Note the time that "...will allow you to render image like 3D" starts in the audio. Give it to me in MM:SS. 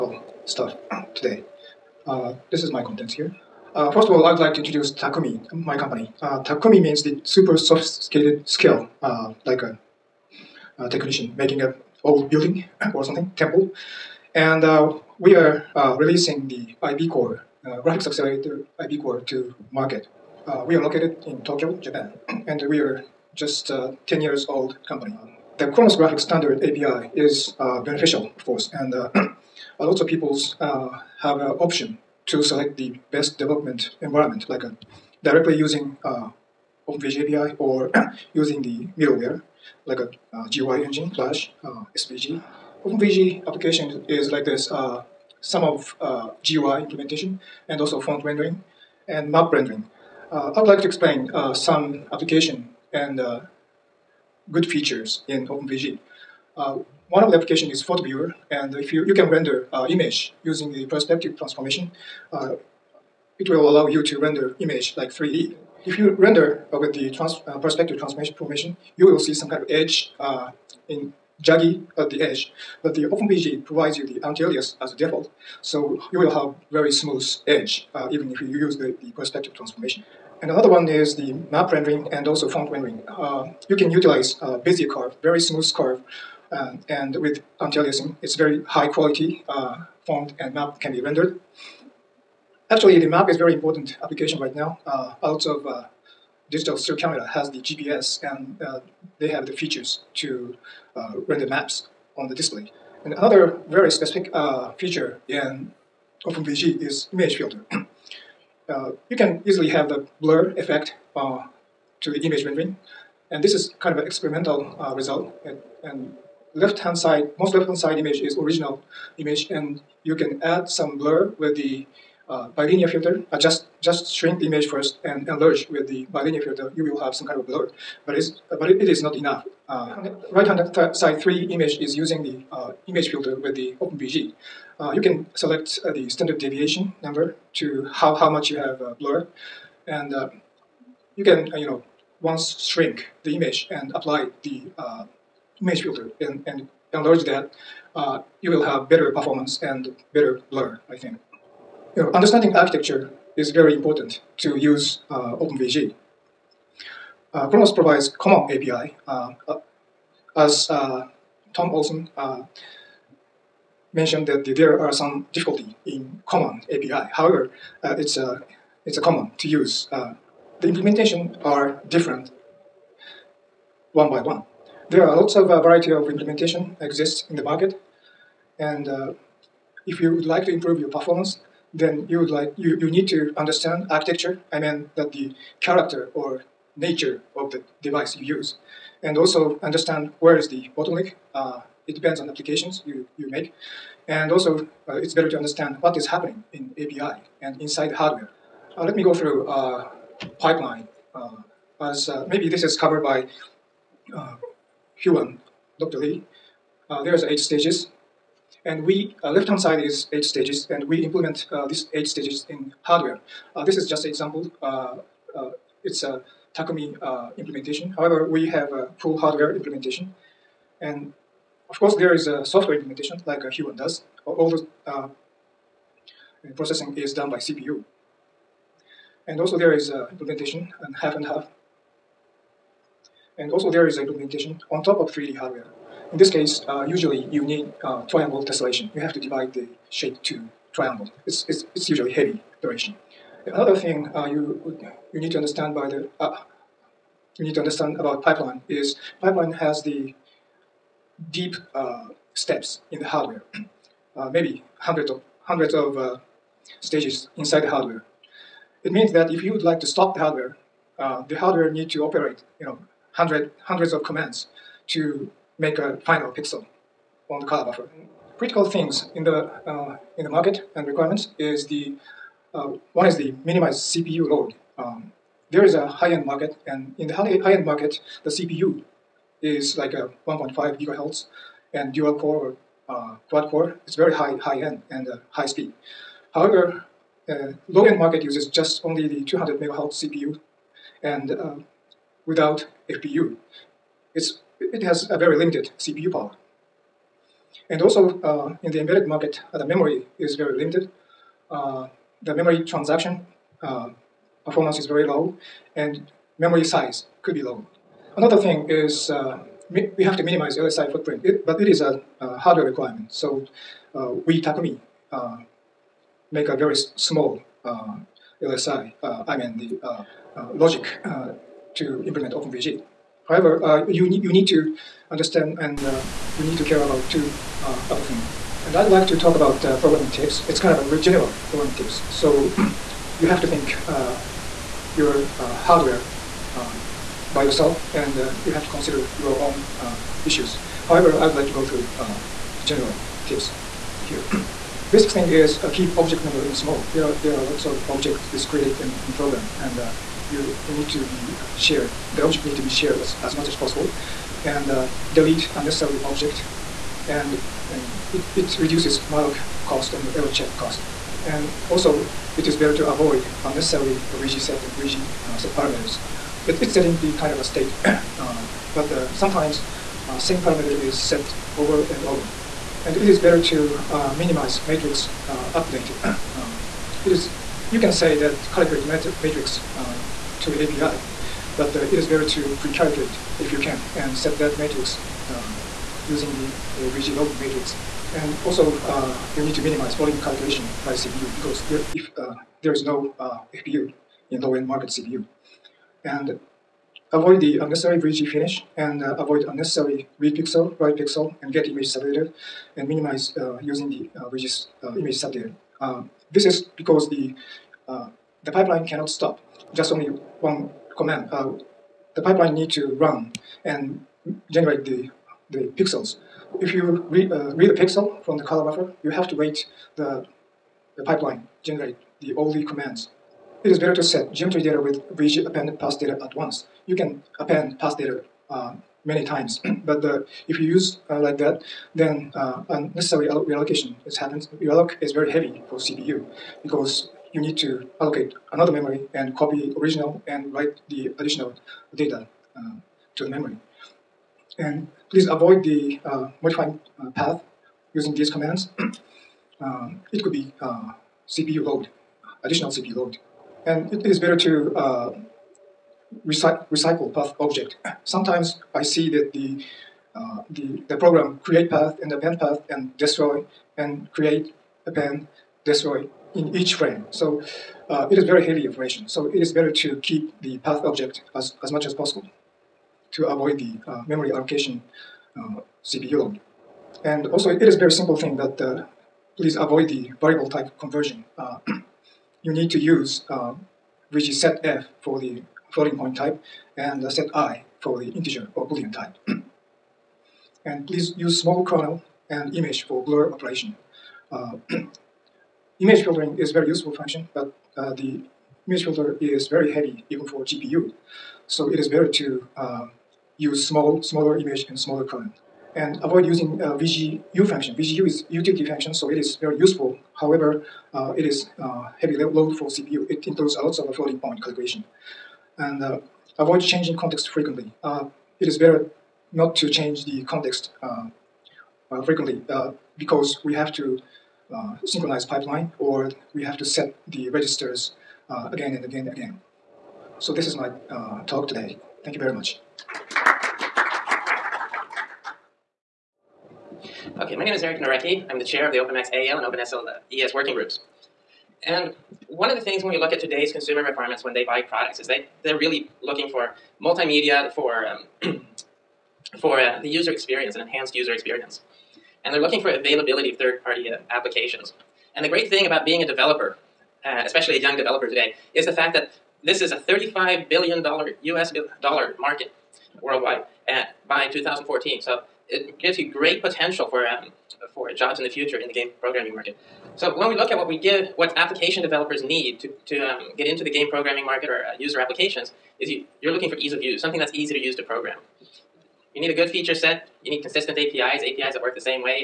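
01:03.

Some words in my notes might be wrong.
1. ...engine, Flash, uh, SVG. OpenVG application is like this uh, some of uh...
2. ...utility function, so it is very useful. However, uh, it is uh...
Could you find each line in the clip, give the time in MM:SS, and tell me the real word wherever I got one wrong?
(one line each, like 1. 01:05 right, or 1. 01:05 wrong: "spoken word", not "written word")
1. 00:40 right
2. 08:28 right.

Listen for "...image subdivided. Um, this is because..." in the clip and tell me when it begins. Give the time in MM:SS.
06:44.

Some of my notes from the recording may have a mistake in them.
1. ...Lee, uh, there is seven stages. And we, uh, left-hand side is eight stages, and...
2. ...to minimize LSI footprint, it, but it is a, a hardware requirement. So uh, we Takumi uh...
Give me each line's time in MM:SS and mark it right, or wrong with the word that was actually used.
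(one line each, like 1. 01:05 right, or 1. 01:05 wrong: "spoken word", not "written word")
1. 03:25 wrong: "eight", not "seven"
2. 05:10 right.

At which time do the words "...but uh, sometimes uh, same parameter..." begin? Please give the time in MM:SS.
06:08.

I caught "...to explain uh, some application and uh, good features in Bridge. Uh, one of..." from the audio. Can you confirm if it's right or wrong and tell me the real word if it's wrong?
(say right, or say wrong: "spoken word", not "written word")
wrong: "OpenVG", not "Bridge".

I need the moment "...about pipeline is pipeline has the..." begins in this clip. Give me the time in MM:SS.
04:07.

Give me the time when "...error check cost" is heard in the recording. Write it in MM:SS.
06:00.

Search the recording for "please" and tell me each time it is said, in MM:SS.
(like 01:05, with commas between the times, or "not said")
07:25, 07:59, 08:10.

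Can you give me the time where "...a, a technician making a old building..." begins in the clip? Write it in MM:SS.
00:09.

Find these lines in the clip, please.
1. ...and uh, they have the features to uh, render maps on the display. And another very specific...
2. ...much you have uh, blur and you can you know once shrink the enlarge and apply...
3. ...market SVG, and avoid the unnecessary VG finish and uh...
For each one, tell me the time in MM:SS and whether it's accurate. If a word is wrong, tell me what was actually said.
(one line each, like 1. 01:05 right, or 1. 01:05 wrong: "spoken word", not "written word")
1. 01:38 right
2. 02:18 wrong: "image", not "enlarge"
3. 06:34 wrong: "CPU", not "SVG".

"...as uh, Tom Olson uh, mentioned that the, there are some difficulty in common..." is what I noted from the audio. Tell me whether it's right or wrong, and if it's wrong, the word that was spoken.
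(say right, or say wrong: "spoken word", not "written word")
right.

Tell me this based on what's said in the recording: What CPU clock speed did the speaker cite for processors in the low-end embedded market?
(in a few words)
200 megahertz.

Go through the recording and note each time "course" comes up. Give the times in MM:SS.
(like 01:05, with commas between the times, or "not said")
00:28, 03:41.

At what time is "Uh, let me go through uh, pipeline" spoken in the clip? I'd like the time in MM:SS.
03:18.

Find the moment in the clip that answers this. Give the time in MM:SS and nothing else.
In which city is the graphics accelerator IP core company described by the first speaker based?
00:21.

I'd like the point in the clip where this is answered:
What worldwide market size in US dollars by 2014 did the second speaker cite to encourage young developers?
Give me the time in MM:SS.
09:19.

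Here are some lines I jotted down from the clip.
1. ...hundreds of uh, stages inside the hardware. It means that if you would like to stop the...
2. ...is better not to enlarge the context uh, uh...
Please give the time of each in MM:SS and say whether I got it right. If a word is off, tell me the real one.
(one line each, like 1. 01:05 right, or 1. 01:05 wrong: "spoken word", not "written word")
1. 04:15 right
2. 08:38 wrong: "change", not "enlarge".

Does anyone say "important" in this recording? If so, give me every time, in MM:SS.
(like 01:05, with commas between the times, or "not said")
01:33, 02:33.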